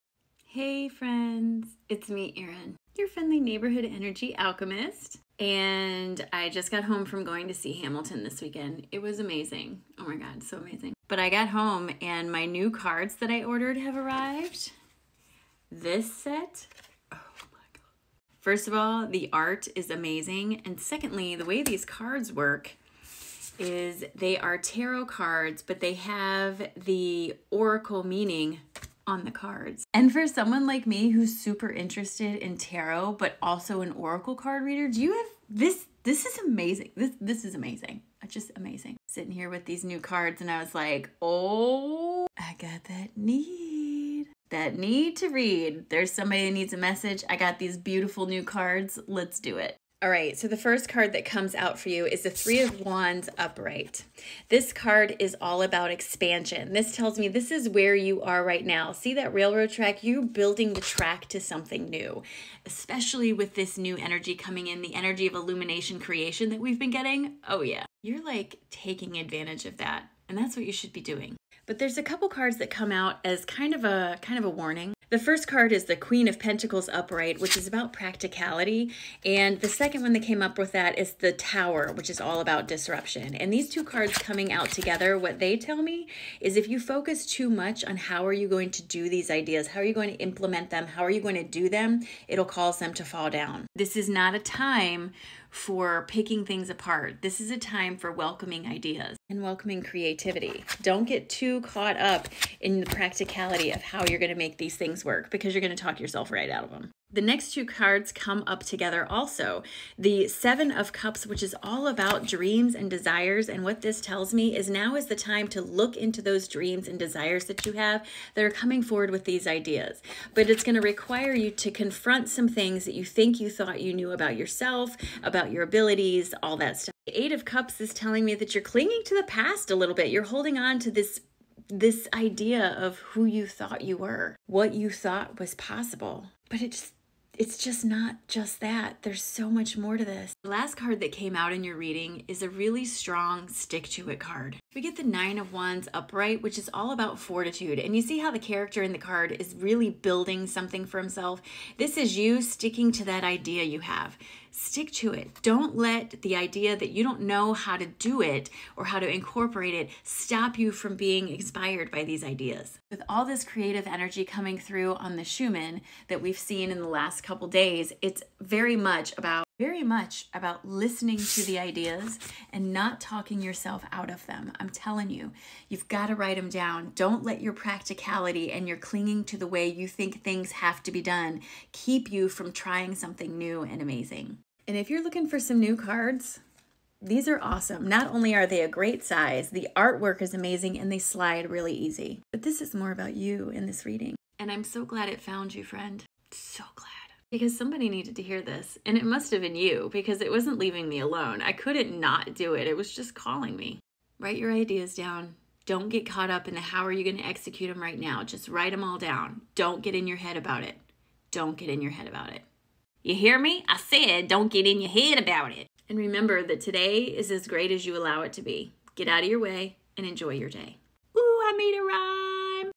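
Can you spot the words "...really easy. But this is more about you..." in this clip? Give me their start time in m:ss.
3:11.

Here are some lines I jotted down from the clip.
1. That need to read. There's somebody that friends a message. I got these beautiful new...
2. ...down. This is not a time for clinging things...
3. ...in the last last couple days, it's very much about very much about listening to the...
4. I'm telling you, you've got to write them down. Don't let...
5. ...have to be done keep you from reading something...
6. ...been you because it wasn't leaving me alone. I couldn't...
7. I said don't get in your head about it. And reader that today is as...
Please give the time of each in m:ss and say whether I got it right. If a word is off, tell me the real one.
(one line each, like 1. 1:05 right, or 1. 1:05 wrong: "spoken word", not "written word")
1. 0:44 wrong: "needs", not "friends"
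2. 1:33 wrong: "picking", not "clinging"
3. 2:46 right
4. 2:54 right
5. 3:00 wrong: "trying", not "reading"
6. 3:19 right
7. 3:33 wrong: "remember", not "reader".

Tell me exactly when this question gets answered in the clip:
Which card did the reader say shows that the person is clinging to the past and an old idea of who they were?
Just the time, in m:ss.
2:07.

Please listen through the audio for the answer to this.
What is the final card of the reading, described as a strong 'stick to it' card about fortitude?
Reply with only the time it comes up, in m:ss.
2:25.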